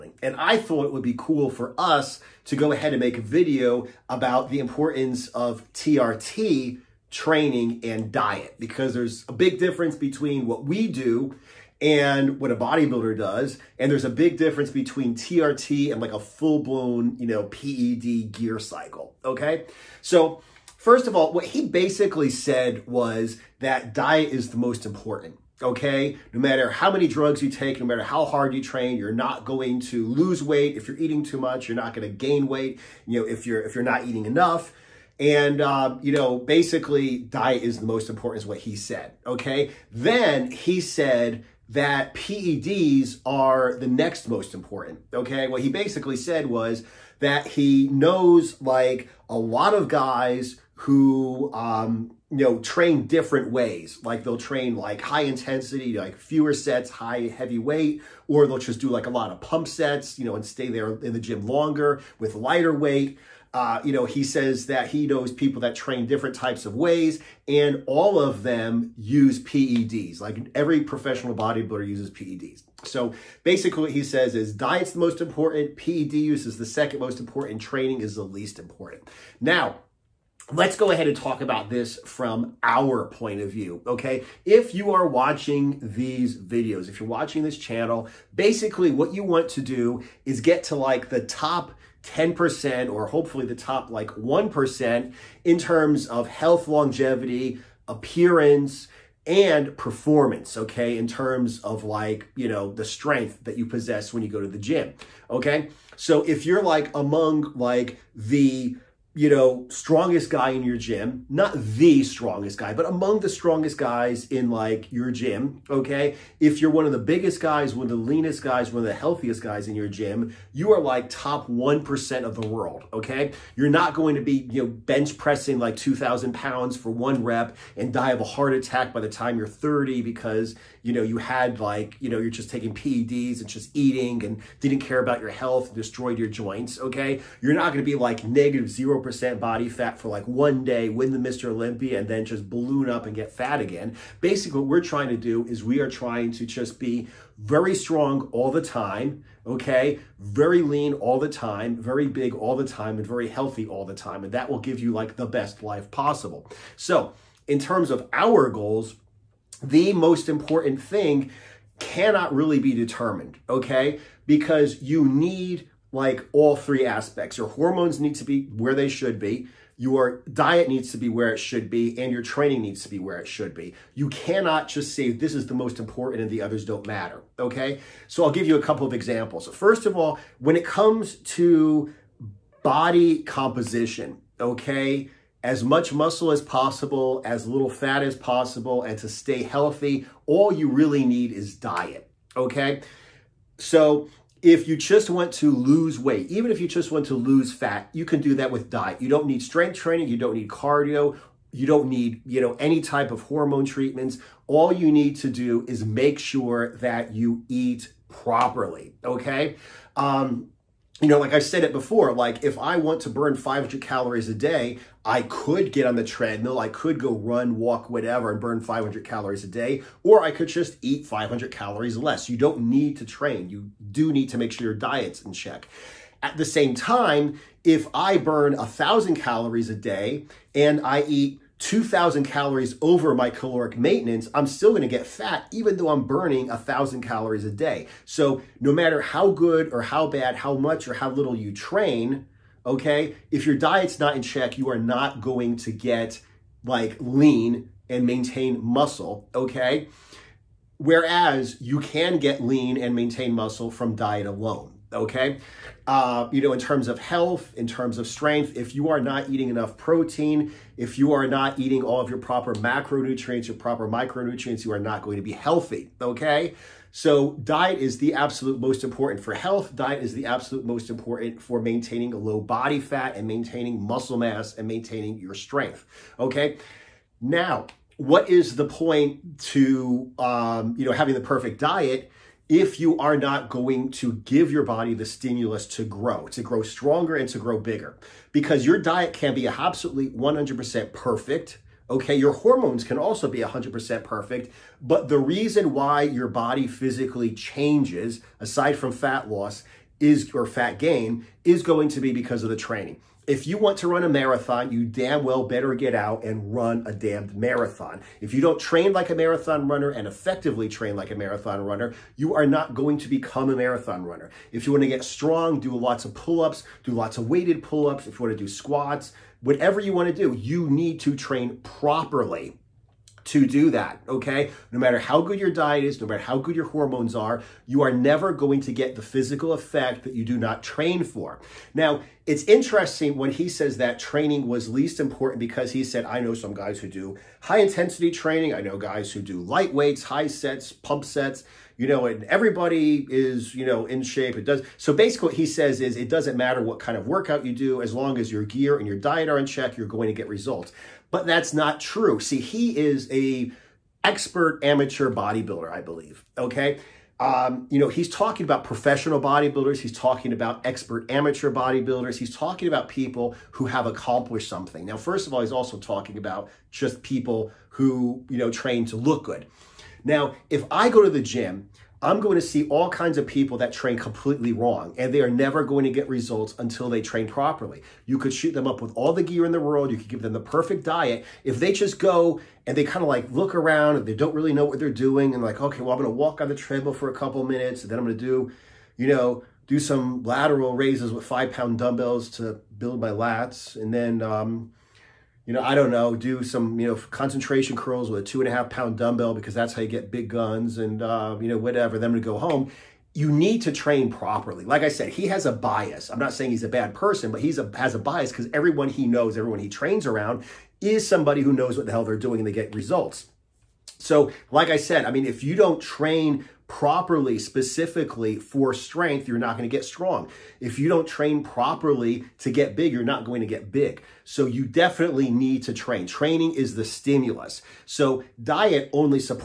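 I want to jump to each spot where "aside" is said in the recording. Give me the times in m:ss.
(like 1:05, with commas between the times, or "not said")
4:58.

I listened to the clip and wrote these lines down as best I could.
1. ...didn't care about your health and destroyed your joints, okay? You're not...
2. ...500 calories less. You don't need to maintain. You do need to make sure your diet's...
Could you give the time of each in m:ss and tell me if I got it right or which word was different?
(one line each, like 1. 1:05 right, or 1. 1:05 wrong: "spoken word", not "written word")
1. 2:14 right
2. 3:41 wrong: "train", not "maintain".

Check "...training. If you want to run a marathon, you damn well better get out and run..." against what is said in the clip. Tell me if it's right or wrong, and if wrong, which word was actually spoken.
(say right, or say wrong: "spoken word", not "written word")
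right.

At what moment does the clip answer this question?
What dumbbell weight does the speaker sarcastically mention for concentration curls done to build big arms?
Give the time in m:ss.
6:38.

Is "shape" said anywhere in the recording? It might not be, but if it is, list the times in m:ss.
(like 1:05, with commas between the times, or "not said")
5:44.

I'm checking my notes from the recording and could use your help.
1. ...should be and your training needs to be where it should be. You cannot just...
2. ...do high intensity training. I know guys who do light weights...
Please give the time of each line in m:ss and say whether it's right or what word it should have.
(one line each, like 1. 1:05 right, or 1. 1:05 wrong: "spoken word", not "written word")
1. 2:51 right
2. 5:36 right.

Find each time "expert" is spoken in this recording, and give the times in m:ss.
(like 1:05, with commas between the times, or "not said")
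5:54, 6:00.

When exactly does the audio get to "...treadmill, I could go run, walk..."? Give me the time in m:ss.
3:36.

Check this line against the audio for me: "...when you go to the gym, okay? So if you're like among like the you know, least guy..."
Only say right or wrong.
wrong.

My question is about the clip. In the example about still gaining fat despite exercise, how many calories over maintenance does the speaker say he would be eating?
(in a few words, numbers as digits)
2,000.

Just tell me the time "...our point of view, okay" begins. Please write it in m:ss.
1:22.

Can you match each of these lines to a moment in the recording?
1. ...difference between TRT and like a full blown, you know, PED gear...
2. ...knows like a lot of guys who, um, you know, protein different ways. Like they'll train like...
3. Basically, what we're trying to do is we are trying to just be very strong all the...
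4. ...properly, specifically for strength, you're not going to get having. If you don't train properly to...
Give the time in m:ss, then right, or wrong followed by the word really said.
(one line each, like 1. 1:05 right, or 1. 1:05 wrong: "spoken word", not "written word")
1. 0:14 right
2. 0:47 wrong: "train", not "protein"
3. 2:24 right
4. 6:56 wrong: "strong", not "having".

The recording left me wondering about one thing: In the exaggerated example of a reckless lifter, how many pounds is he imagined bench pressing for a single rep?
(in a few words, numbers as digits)
2,000.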